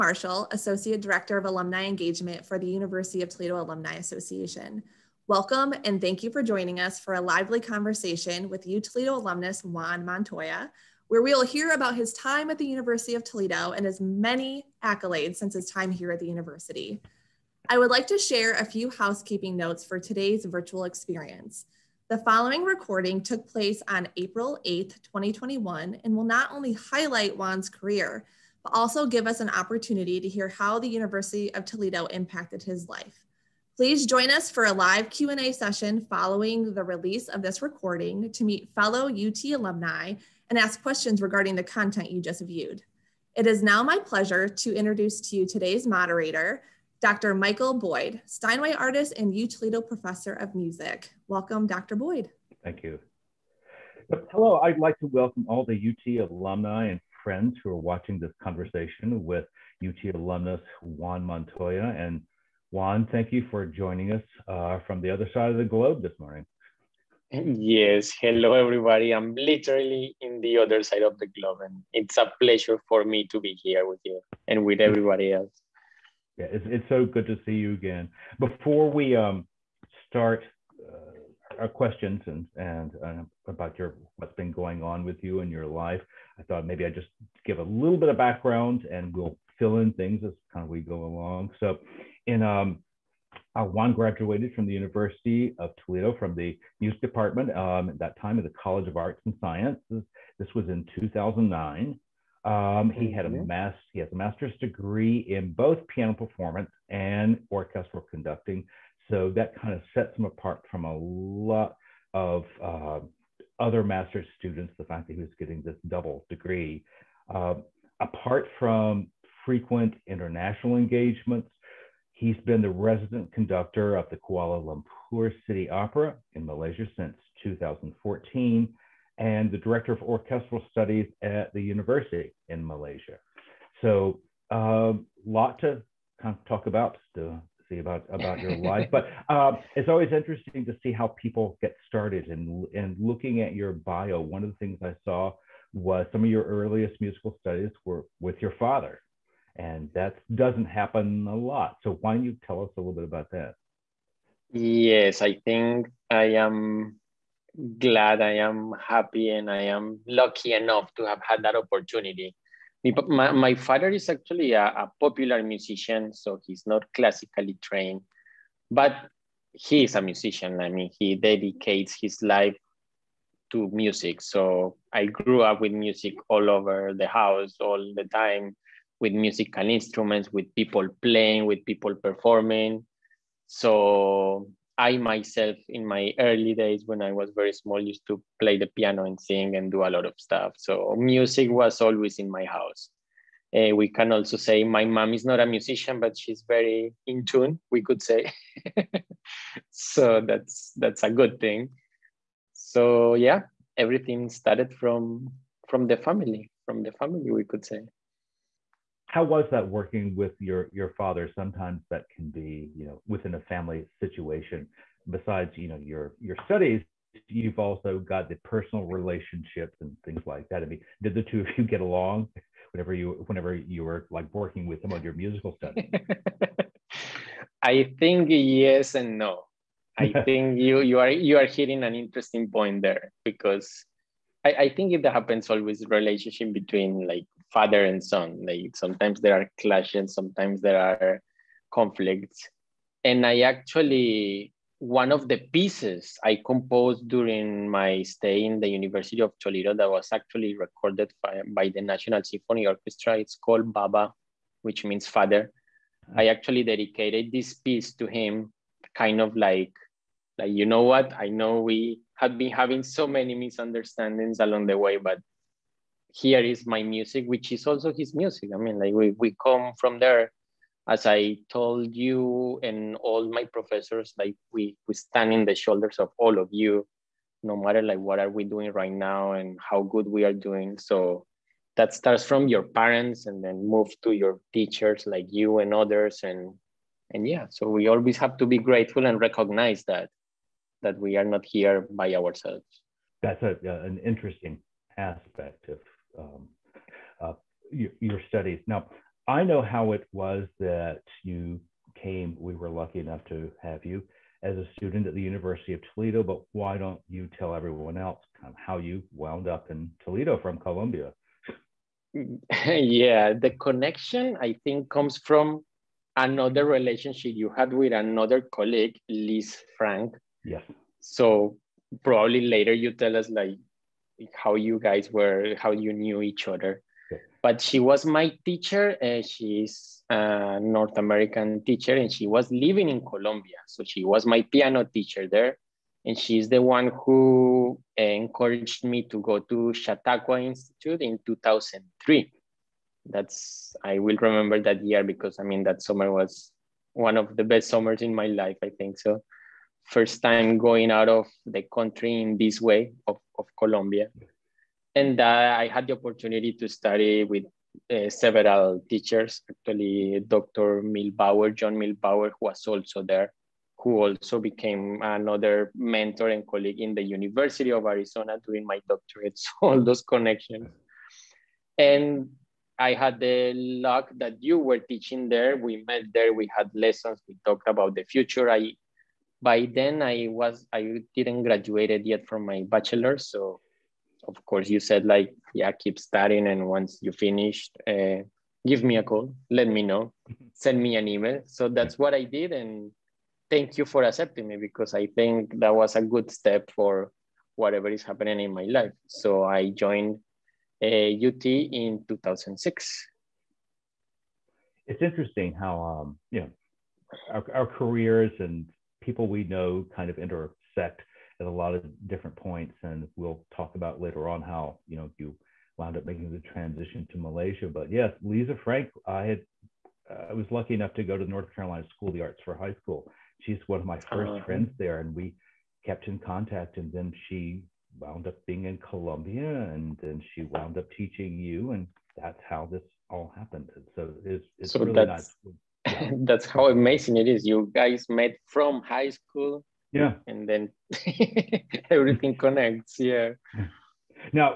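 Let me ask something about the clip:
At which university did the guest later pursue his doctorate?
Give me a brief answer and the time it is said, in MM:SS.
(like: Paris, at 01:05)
University of Arizona, at 06:07.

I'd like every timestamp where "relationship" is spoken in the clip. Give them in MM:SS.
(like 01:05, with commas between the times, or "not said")
03:38, 03:55, 05:16.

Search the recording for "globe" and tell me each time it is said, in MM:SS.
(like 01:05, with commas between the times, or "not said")
01:05, 01:11.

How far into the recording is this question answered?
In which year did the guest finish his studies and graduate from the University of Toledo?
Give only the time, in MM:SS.
01:40.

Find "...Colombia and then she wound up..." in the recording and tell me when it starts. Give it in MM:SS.
07:08.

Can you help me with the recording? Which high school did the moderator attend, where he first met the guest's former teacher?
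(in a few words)
North Carolina School of the Arts.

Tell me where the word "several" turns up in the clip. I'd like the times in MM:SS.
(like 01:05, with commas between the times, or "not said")
05:58.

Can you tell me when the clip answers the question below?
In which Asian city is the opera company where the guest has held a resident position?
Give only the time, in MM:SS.
02:04.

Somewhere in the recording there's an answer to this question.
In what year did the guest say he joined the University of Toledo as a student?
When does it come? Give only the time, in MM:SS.
06:42.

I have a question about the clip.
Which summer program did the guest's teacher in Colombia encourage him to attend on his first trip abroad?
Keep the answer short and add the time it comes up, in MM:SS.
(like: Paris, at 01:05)
Chautauqua Institute, at 05:39.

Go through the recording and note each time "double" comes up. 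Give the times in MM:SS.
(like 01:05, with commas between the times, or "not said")
01:55.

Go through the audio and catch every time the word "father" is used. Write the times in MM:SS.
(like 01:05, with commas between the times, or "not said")
02:28, 02:43, 03:30, 03:57, 04:15.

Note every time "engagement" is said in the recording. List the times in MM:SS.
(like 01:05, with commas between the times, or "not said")
00:01, 02:00.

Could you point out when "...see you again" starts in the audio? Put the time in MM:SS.
01:17.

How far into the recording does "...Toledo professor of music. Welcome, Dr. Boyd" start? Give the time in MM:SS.
00:49.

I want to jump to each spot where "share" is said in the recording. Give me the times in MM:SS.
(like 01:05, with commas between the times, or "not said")
00:18.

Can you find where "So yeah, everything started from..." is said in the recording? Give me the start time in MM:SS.
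03:22.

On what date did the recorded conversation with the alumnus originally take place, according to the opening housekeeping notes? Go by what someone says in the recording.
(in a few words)
April 8, 2021.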